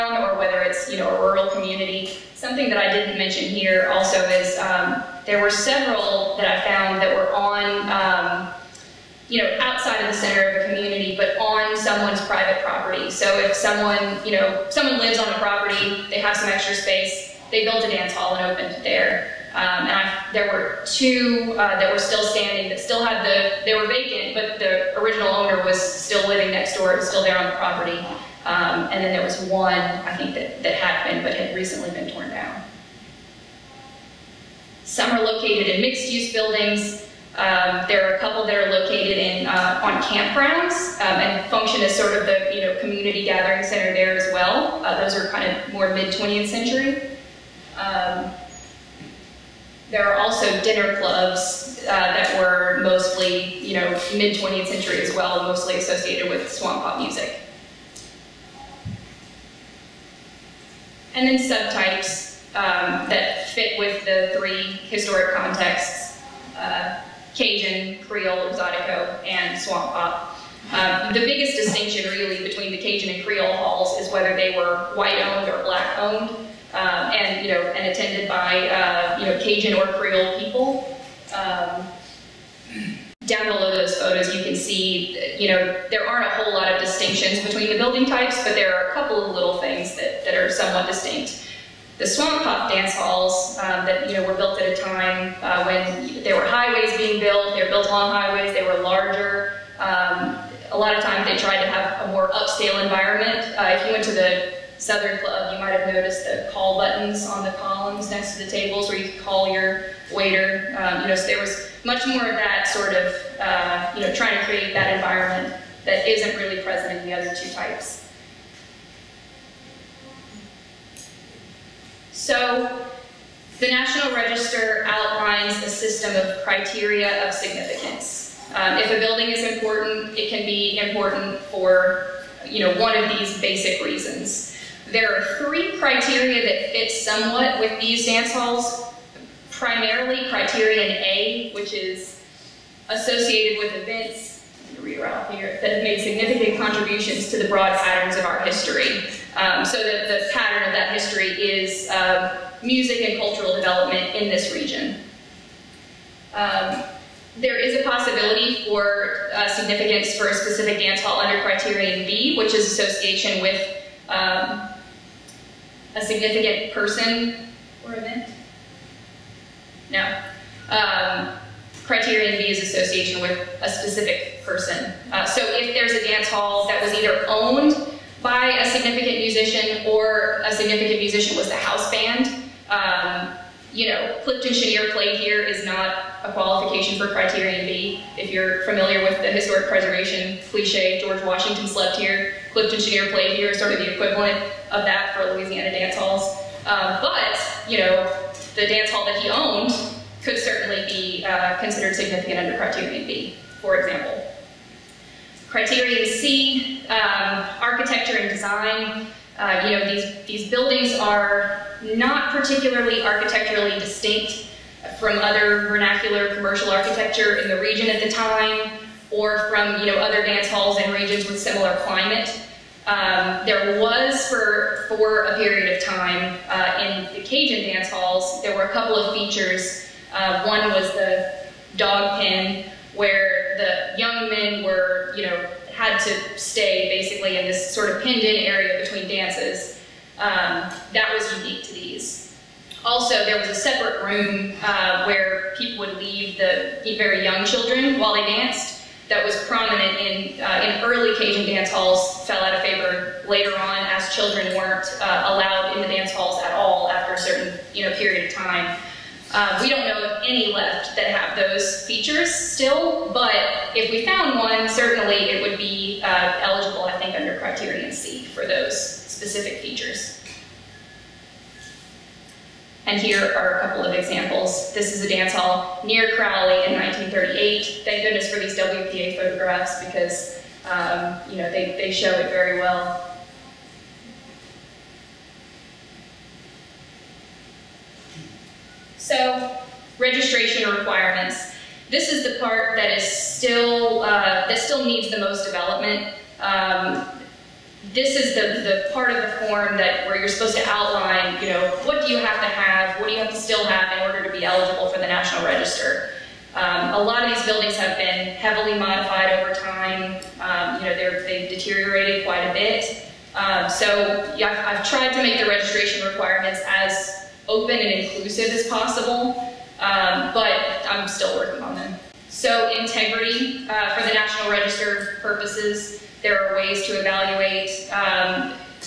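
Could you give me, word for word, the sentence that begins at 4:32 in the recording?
And here are a couple of examples.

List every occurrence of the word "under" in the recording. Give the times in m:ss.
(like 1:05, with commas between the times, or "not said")
2:41, 3:22, 4:27.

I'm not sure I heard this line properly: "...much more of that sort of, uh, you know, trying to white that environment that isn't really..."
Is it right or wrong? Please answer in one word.
wrong.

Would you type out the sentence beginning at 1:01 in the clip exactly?
And then subtypes um, that fit with the three historic contexts.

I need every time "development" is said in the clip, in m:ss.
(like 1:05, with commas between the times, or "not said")
2:33, 4:55.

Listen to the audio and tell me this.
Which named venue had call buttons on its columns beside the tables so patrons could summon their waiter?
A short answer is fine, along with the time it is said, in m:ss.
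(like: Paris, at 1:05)
Southern Club, at 1:44.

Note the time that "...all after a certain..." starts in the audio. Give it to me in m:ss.
4:16.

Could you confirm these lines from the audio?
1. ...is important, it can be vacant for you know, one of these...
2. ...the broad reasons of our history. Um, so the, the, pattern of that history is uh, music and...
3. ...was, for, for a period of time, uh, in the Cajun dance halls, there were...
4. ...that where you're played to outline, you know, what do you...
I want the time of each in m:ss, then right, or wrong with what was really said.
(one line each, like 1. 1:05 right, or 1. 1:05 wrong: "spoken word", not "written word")
1. 2:09 wrong: "important", not "vacant"
2. 2:27 wrong: "patterns", not "reasons"
3. 3:43 right
4. 4:59 wrong: "supposed", not "played".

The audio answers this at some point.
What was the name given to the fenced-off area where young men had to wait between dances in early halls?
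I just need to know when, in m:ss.
3:51.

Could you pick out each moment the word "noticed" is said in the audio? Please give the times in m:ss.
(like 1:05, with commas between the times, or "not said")
1:45.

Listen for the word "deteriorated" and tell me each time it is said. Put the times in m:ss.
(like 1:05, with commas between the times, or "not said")
5:11.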